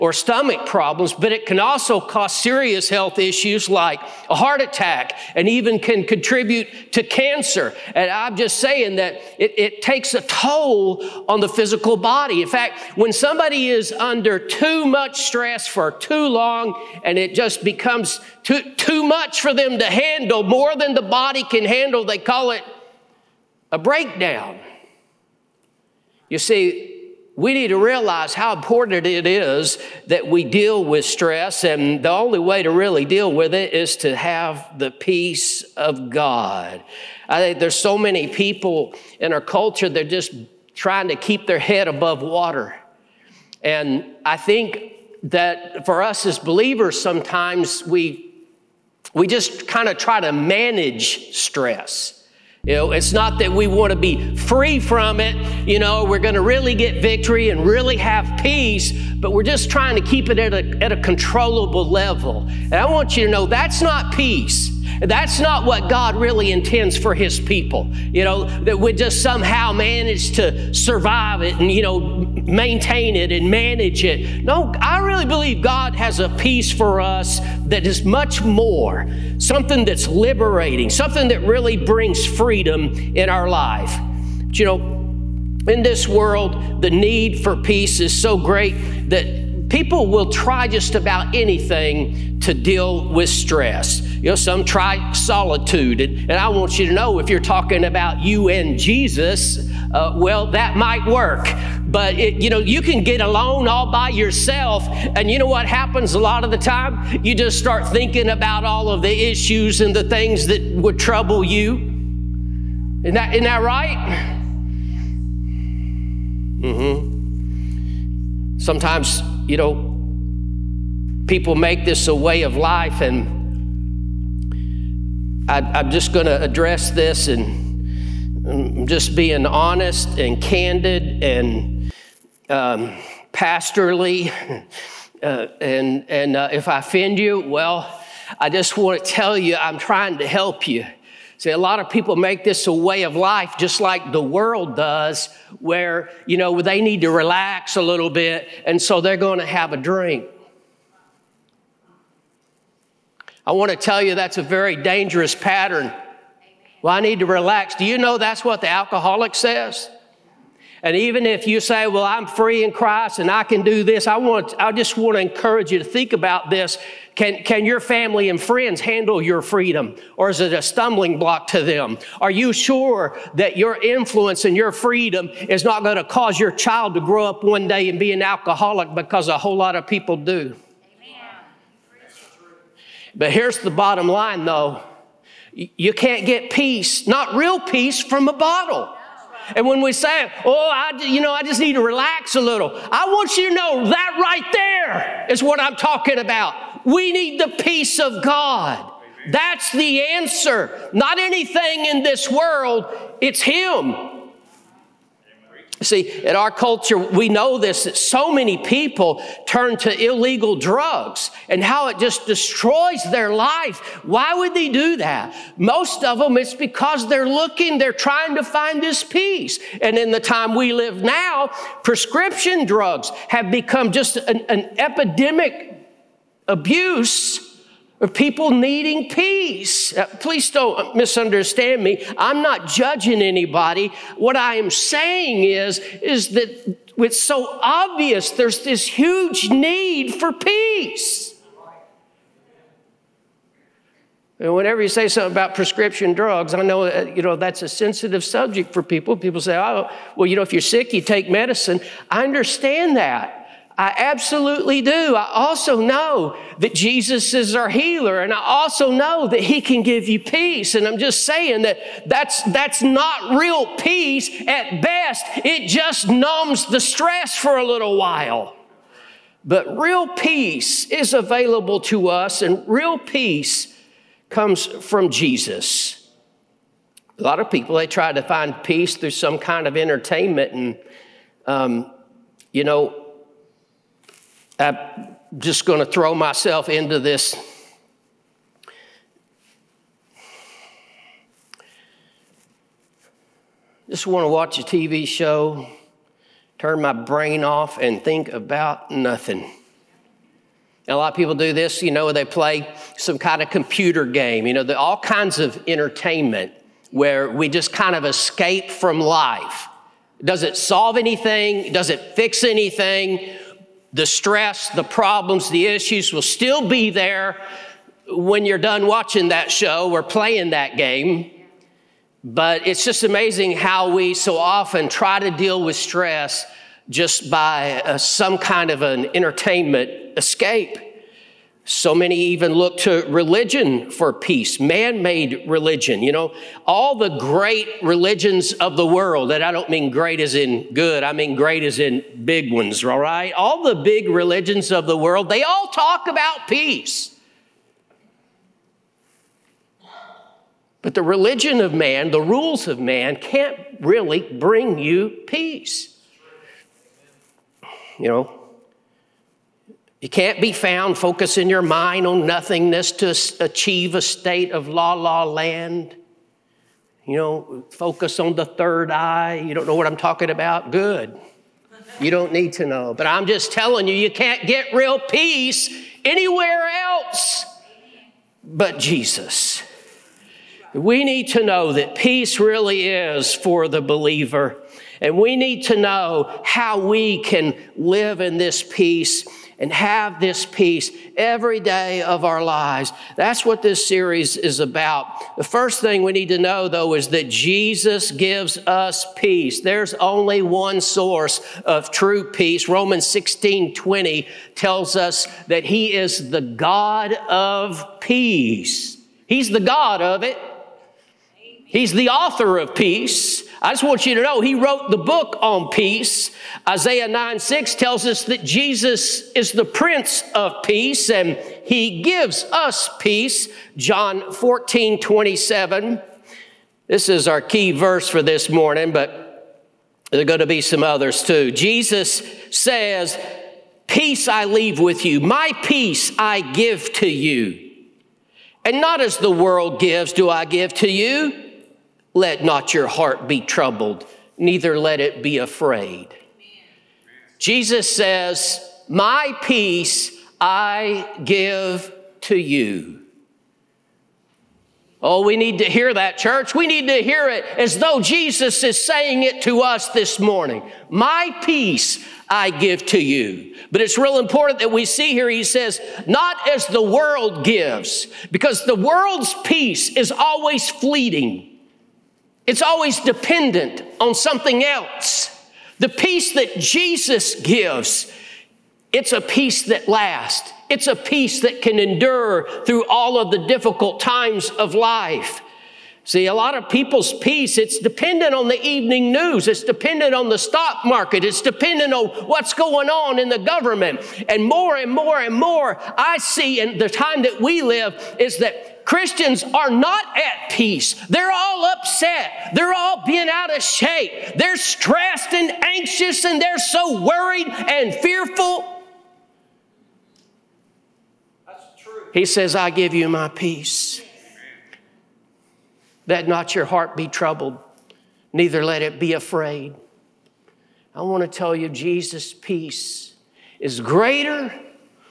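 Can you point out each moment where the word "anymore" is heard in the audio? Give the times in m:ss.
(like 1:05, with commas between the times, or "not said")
not said.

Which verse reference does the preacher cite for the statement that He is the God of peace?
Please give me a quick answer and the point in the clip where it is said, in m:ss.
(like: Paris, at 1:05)
Romans 16:20, at 6:42.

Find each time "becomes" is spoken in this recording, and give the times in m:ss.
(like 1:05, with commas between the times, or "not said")
0:17, 3:43.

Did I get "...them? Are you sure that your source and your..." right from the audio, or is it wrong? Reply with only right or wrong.
wrong.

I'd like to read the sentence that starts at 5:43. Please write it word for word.
All the big religions of the world, they all talk about peace.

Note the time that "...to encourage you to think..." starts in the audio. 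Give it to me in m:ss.
2:45.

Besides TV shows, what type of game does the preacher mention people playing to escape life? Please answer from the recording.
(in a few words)
computer game.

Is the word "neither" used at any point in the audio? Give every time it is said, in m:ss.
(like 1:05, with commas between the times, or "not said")
7:24, 8:38.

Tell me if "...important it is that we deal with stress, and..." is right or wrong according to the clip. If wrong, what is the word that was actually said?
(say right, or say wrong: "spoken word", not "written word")
right.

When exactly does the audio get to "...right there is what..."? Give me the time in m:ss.
3:14.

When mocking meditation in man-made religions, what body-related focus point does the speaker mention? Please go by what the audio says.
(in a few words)
the third eye.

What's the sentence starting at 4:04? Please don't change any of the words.
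And whenever you say something about prescription drugs, I know uh, you know that's a sensitive subject for people.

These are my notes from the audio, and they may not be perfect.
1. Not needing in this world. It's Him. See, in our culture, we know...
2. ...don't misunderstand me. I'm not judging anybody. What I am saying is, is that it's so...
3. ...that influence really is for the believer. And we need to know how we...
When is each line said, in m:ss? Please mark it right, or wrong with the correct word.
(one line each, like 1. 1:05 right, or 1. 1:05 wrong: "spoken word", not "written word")
1. 3:20 wrong: "anything", not "needing"
2. 3:50 right
3. 6:21 wrong: "peace", not "influence".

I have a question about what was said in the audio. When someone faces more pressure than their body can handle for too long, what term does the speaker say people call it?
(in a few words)
a breakdown.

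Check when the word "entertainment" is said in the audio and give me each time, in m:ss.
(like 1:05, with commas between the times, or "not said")
4:39, 5:05, 5:29.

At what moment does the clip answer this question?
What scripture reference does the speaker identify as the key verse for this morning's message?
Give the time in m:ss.
7:03.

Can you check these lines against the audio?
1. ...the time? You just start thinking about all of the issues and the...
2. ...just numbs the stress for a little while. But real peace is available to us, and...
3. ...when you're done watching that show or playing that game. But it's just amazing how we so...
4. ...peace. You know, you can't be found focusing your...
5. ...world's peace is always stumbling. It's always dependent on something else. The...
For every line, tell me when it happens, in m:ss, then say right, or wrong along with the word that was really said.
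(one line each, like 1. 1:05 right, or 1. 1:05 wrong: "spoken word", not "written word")
1. 1:46 right
2. 4:25 right
3. 5:18 right
4. 5:55 right
5. 7:48 wrong: "fleeting", not "stumbling".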